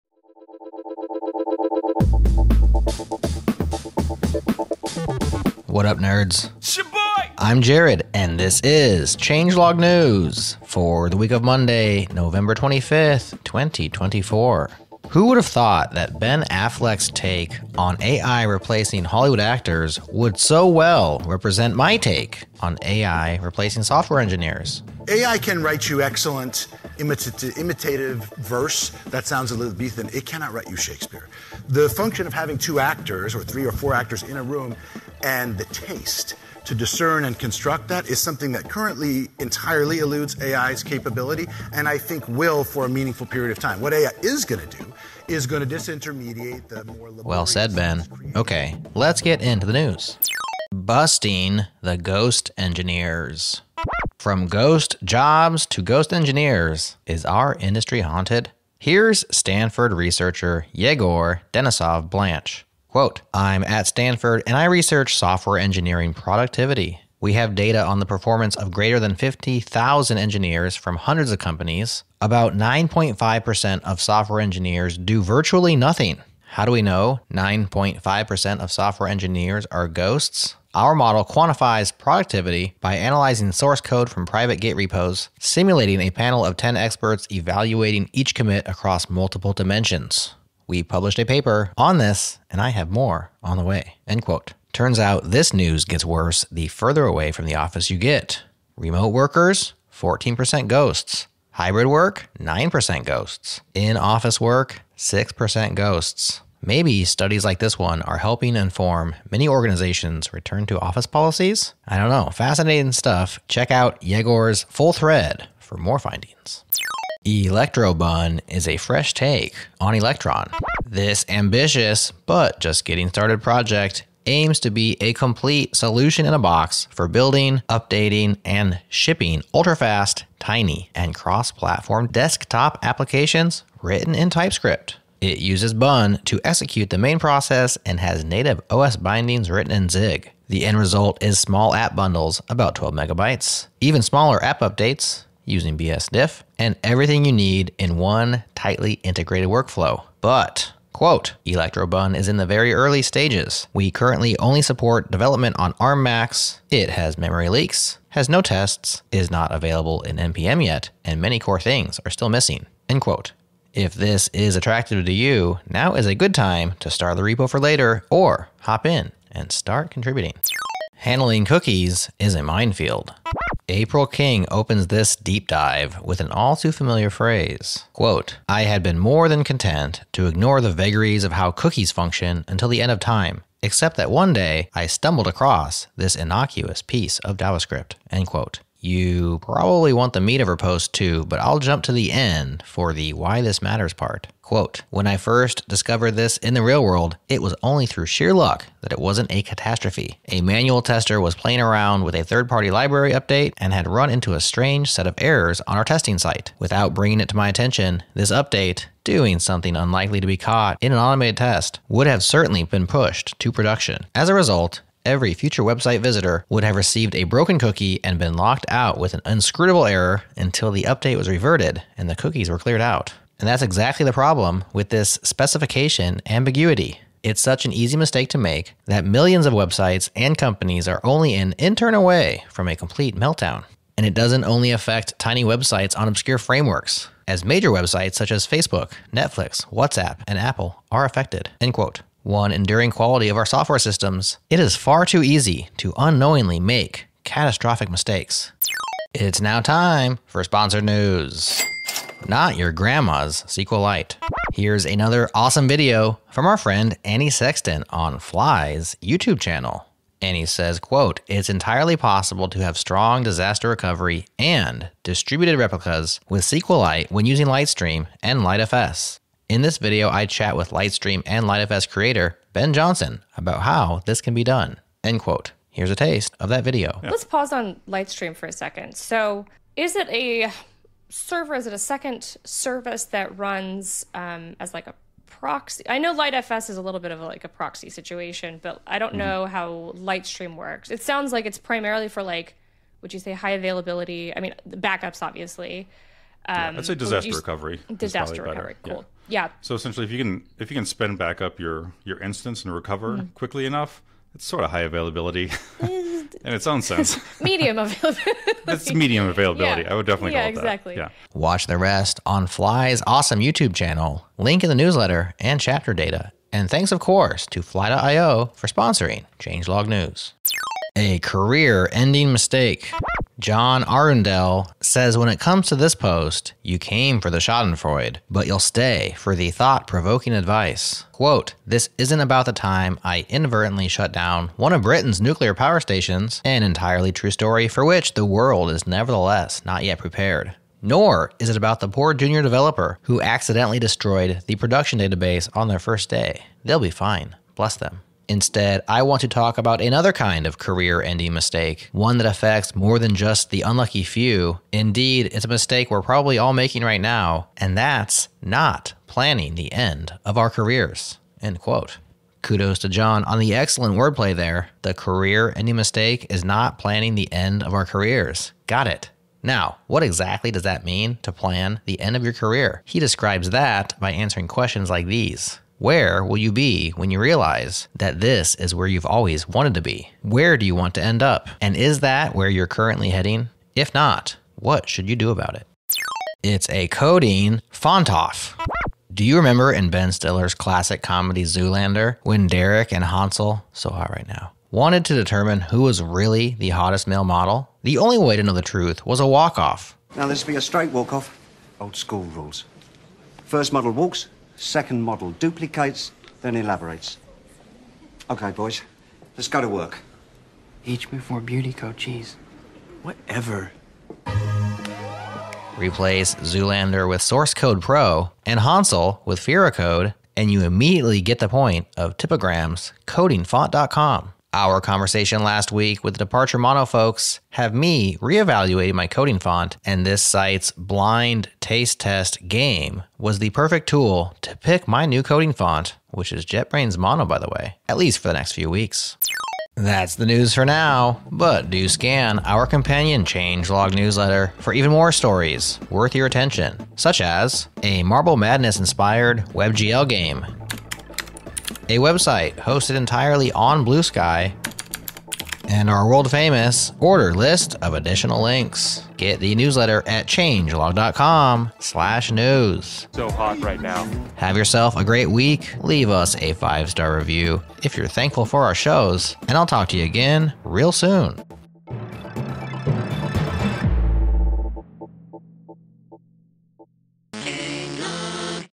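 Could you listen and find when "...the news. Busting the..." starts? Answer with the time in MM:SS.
00:49.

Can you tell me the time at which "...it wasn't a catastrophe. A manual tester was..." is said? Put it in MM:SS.
03:18.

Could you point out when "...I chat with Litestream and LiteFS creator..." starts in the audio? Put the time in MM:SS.
04:30.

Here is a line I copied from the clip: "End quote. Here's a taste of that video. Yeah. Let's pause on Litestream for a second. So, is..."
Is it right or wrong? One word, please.
right.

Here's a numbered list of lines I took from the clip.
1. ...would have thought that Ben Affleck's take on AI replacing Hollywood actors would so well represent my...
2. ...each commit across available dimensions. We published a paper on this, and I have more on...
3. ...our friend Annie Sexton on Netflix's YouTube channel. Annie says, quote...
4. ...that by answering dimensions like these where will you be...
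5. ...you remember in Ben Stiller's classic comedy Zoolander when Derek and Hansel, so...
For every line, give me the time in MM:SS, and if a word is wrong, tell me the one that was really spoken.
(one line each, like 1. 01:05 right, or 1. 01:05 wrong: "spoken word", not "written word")
1. 00:15 right
2. 01:28 wrong: "multiple", not "available"
3. 04:16 wrong: "Fly", not "Netflix"
4. 06:13 wrong: "questions", not "dimensions"
5. 06:29 right.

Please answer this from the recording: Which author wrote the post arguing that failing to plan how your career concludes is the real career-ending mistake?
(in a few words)
John Arundel.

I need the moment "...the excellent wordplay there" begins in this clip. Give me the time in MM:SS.
06:03.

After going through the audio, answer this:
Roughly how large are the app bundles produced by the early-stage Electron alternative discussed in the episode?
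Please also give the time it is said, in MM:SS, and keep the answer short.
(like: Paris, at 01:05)
12 megabytes, at 02:22.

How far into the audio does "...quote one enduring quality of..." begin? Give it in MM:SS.
04:01.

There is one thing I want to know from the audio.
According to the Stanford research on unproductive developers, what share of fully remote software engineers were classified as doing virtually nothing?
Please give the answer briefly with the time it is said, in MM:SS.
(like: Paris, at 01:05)
14%, at 01:39.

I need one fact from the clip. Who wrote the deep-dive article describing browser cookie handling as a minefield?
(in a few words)
April King.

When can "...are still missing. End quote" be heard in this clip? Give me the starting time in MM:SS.
02:42.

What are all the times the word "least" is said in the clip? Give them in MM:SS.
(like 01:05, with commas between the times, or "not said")
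07:17.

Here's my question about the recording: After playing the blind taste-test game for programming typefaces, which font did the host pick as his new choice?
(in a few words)
JetBrains Mono.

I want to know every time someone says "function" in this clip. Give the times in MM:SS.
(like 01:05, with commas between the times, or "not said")
00:31, 03:01.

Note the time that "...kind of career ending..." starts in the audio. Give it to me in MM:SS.
05:50.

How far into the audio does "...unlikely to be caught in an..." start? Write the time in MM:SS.
03:29.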